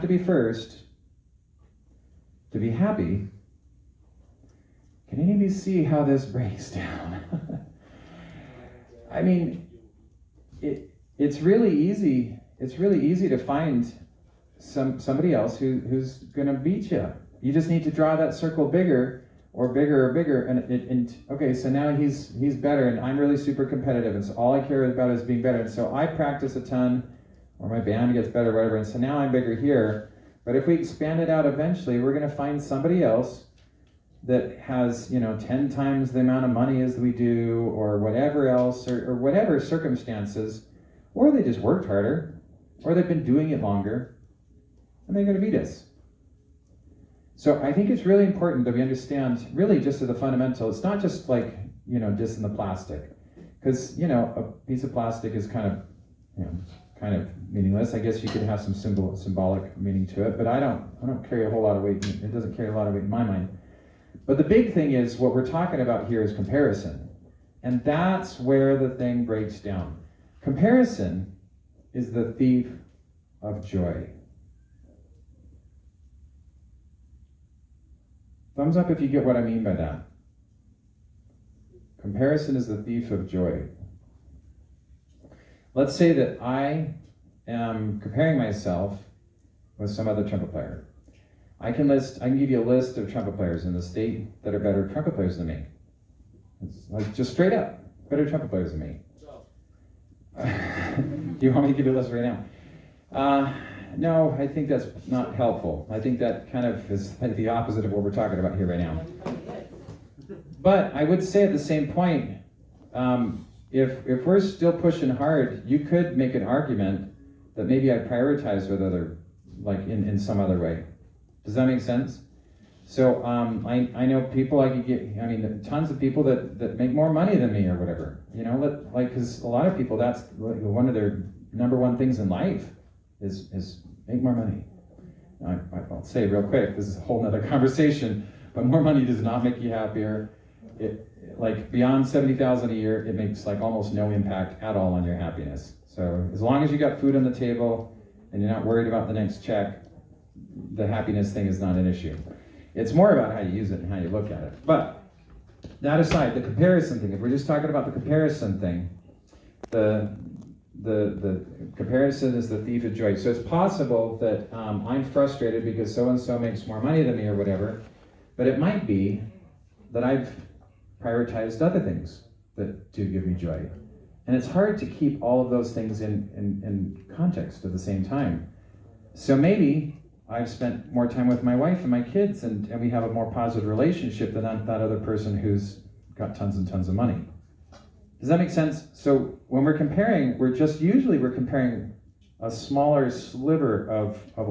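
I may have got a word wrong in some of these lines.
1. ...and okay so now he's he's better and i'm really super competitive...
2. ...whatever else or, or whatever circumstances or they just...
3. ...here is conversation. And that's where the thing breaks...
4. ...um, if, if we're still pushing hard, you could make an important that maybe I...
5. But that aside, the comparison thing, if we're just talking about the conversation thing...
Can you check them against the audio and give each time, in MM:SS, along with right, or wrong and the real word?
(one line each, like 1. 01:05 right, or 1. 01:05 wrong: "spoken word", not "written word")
1. 00:20 right
2. 00:37 right
3. 01:06 wrong: "comparison", not "conversation"
4. 01:52 wrong: "argument", not "important"
5. 02:34 wrong: "comparison", not "conversation".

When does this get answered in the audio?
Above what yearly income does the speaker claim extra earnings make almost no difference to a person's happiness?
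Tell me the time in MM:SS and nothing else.
02:22.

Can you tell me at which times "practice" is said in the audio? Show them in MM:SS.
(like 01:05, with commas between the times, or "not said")
00:26.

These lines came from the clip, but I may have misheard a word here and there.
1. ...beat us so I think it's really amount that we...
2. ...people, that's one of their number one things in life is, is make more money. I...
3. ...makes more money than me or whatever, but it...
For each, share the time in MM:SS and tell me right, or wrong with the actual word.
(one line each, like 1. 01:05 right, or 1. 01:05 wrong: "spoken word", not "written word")
1. 00:45 wrong: "important", not "amount"
2. 02:09 right
3. 02:46 right.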